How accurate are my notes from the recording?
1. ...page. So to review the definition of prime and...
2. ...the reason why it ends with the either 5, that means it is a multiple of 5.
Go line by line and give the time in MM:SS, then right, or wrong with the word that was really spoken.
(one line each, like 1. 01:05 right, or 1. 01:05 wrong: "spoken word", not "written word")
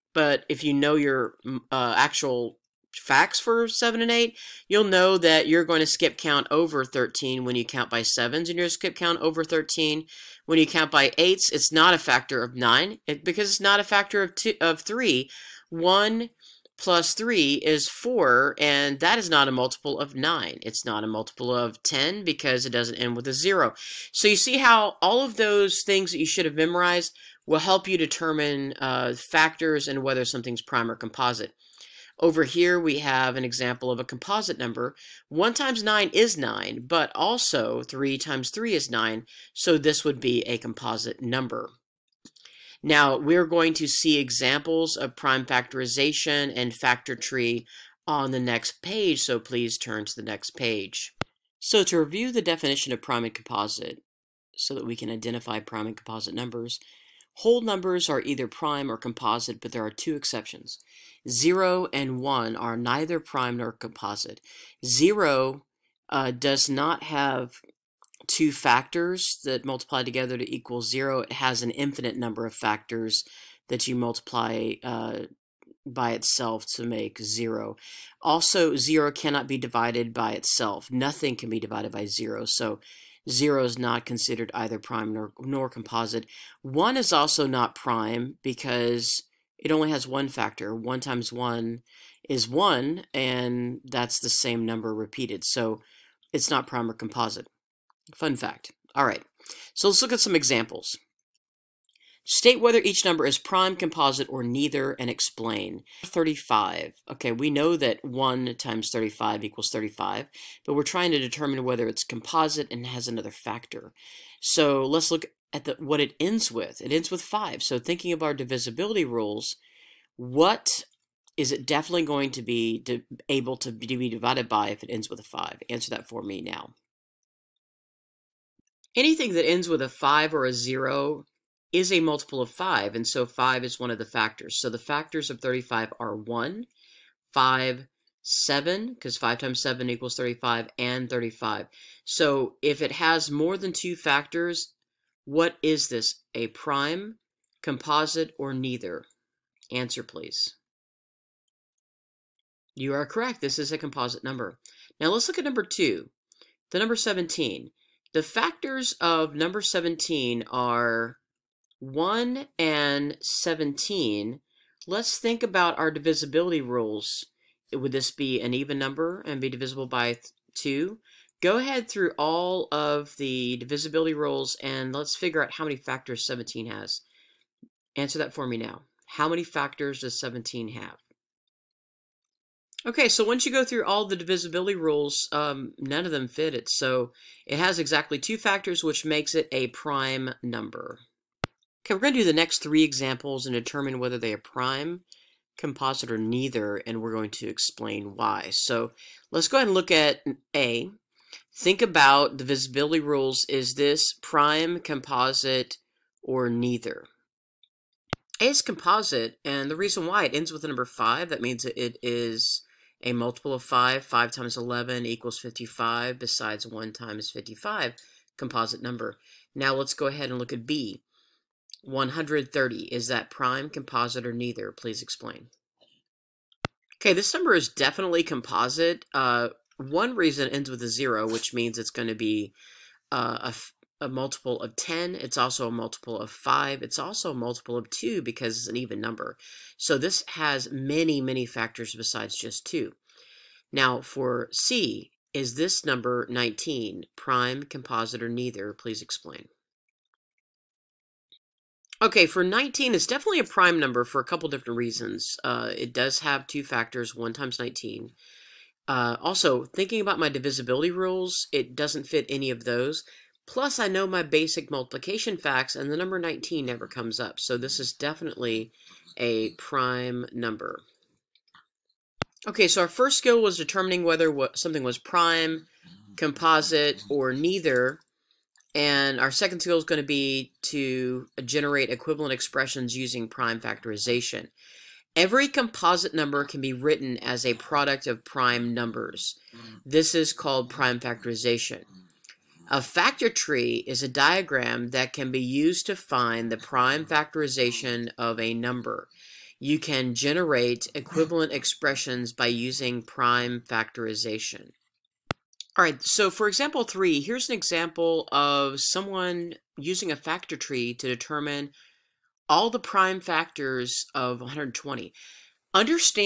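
1. 00:50 right
2. 03:29 wrong: "number", not "either".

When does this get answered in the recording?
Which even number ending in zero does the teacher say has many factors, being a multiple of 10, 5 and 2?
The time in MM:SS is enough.
03:41.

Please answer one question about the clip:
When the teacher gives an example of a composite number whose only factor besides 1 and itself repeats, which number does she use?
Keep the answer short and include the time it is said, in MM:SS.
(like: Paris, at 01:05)
9, at 00:35.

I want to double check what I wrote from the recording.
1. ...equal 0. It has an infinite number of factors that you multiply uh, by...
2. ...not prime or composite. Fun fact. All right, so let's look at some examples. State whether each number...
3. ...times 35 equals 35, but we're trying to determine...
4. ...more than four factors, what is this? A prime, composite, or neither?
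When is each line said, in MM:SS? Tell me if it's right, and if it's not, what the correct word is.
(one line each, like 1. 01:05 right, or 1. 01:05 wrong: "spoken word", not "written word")
1. 01:10 right
2. 01:36 right
3. 01:48 right
4. 02:23 wrong: "two", not "four".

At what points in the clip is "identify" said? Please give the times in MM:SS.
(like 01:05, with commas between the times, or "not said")
00:55.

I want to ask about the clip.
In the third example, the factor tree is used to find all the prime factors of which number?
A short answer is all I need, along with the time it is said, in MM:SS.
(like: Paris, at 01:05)
120, at 05:14.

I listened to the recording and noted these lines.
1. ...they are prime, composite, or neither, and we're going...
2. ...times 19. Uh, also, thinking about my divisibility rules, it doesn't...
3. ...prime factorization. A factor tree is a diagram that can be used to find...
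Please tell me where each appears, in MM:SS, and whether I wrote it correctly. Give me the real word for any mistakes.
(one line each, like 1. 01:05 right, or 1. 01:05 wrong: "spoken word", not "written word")
1. 03:14 right
2. 04:17 right
3. 04:50 right.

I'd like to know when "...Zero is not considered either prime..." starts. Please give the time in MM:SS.
01:23.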